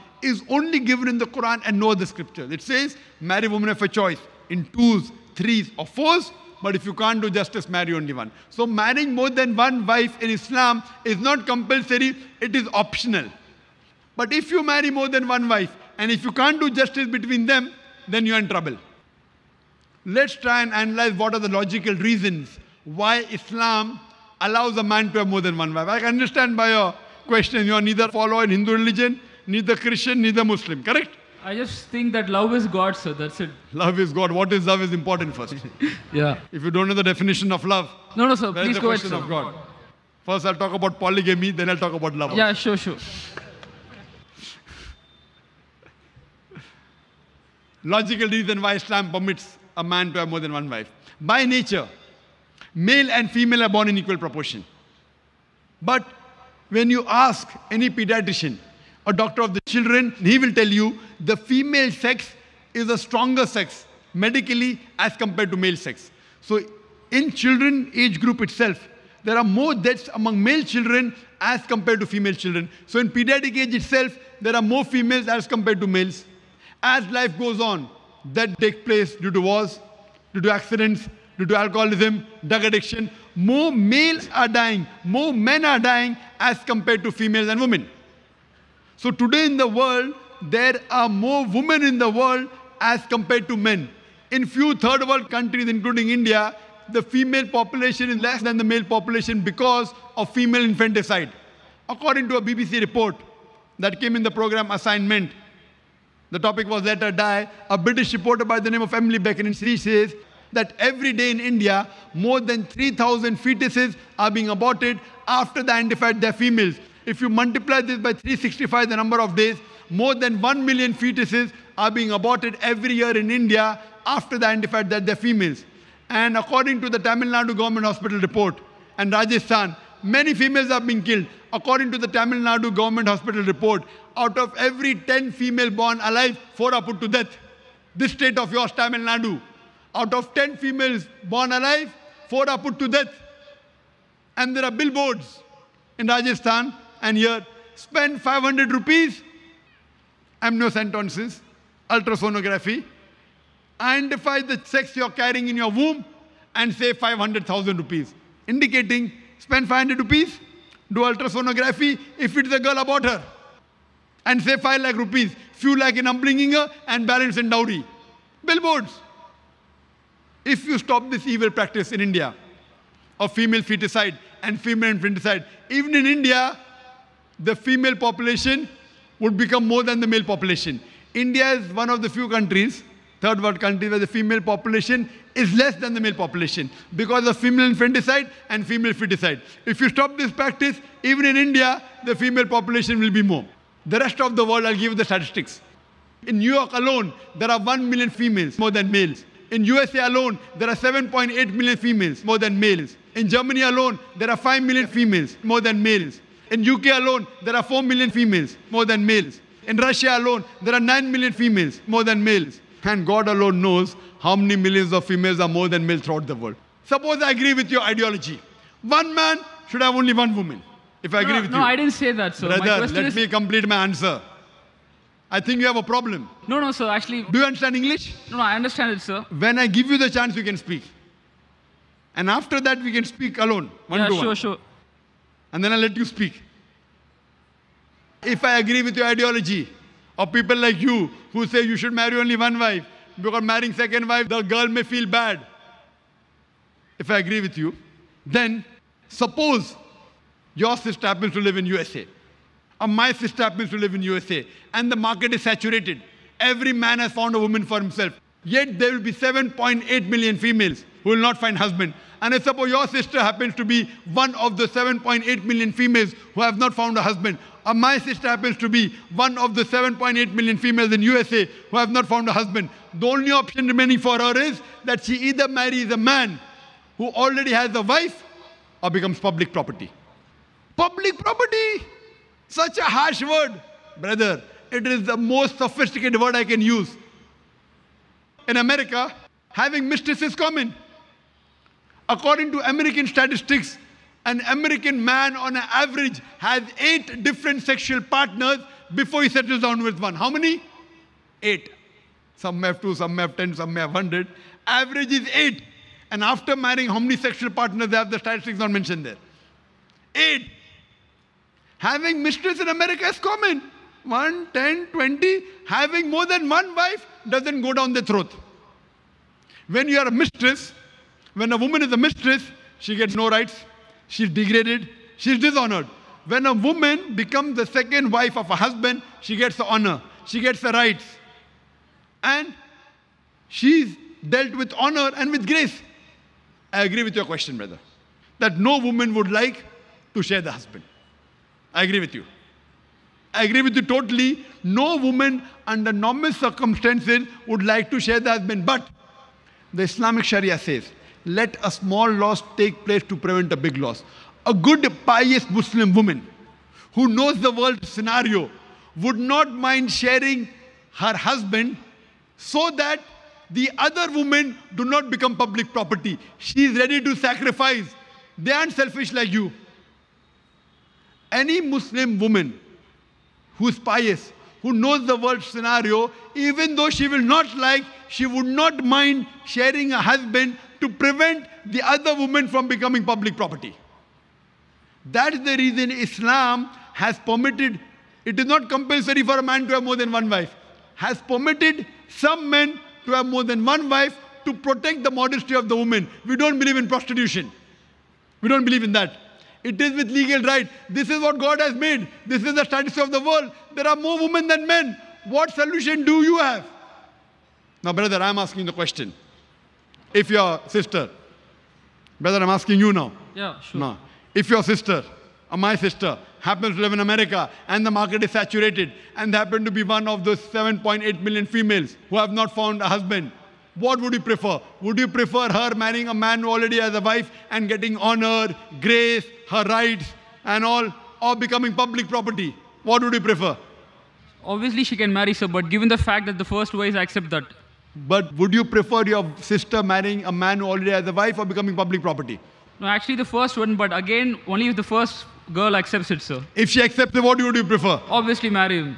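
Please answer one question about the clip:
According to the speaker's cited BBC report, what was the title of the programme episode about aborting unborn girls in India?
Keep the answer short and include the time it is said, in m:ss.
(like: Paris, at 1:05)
Let Her Die, at 1:46.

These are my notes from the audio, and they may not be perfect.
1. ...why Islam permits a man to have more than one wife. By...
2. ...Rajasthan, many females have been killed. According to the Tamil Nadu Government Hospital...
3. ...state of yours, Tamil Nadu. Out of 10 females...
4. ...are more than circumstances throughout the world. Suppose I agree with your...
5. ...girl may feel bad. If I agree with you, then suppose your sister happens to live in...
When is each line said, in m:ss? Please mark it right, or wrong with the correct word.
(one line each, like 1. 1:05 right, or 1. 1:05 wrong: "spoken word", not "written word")
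1. 0:48 right
2. 2:09 right
3. 2:18 right
4. 3:35 wrong: "males", not "circumstances"
5. 4:04 right.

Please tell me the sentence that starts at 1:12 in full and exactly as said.
So in pediatric age itself, there are more females as compared to males.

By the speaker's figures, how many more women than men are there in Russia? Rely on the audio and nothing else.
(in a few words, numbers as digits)
9 million.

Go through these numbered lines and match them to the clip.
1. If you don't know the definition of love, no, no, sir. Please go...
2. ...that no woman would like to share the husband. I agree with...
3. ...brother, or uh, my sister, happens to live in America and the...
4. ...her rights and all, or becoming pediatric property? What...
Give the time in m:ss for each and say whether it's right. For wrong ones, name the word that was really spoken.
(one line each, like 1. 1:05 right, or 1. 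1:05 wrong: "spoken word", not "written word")
1. 0:36 right
2. 5:38 right
3. 6:54 wrong: "sister", not "brother"
4. 7:09 wrong: "public", not "pediatric".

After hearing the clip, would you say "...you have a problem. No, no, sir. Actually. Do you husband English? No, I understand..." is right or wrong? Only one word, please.
wrong.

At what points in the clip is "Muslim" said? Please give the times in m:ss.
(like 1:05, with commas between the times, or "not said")
0:30, 5:55, 6:11.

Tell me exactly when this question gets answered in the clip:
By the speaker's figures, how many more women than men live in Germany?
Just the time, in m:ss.
3:24.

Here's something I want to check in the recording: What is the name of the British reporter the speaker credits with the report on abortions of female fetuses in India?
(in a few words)
Emily Buchanan.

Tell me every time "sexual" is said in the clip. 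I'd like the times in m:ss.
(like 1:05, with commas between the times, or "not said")
4:57, 5:07.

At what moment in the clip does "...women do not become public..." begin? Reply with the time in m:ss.
6:04.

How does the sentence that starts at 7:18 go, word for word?
But would you prefer your sister marrying a man who already has a wife or becoming public property?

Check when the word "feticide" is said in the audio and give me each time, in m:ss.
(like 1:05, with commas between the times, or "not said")
2:53, 3:08.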